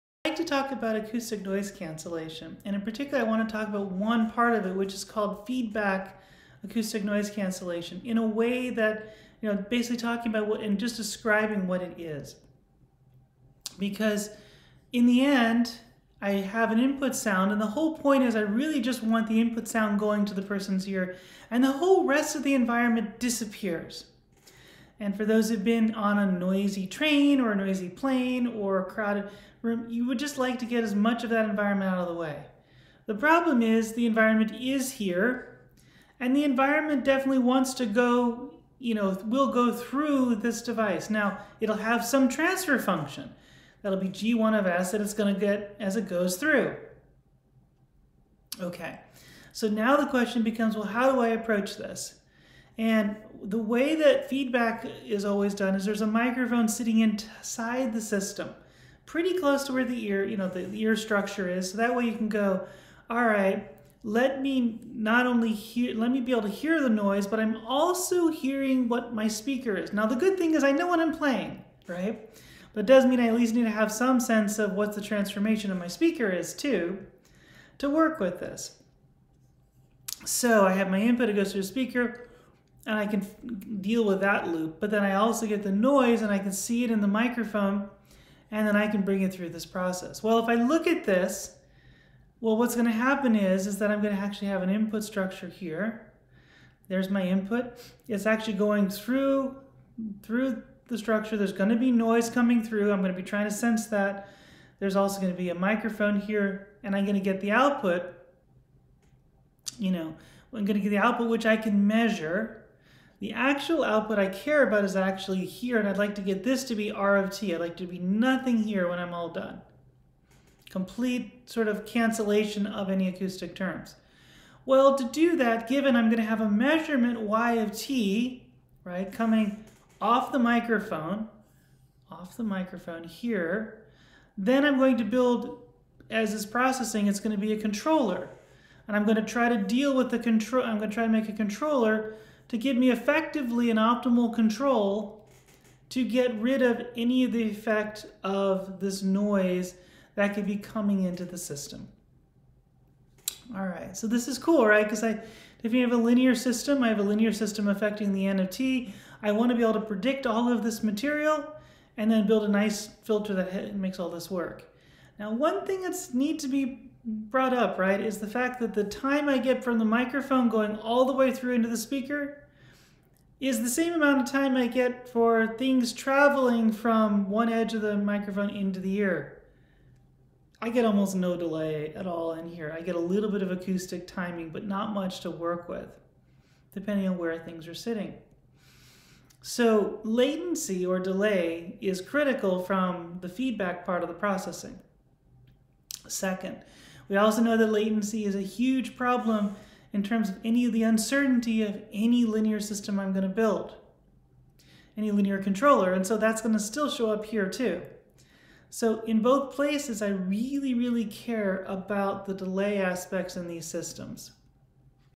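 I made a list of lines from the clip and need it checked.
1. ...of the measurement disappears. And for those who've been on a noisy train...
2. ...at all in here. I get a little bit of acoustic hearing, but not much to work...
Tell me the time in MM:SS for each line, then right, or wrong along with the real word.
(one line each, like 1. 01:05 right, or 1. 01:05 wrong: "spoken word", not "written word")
1. 00:22 wrong: "environment", not "measurement"
2. 03:01 wrong: "timing", not "hearing".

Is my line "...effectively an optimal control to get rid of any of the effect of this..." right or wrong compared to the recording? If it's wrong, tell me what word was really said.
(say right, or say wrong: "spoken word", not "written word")
right.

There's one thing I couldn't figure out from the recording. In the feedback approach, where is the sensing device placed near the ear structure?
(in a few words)
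Inside the system.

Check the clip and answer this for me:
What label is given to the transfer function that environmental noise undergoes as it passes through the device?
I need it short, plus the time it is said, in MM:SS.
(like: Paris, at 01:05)
G1 of S, at 00:44.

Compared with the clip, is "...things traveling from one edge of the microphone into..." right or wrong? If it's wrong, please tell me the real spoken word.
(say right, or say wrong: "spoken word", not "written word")
right.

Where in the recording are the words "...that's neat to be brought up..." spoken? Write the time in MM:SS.
02:45.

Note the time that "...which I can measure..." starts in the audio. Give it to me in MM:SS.
01:51.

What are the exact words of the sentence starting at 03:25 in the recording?
And so that's going to still show up here too.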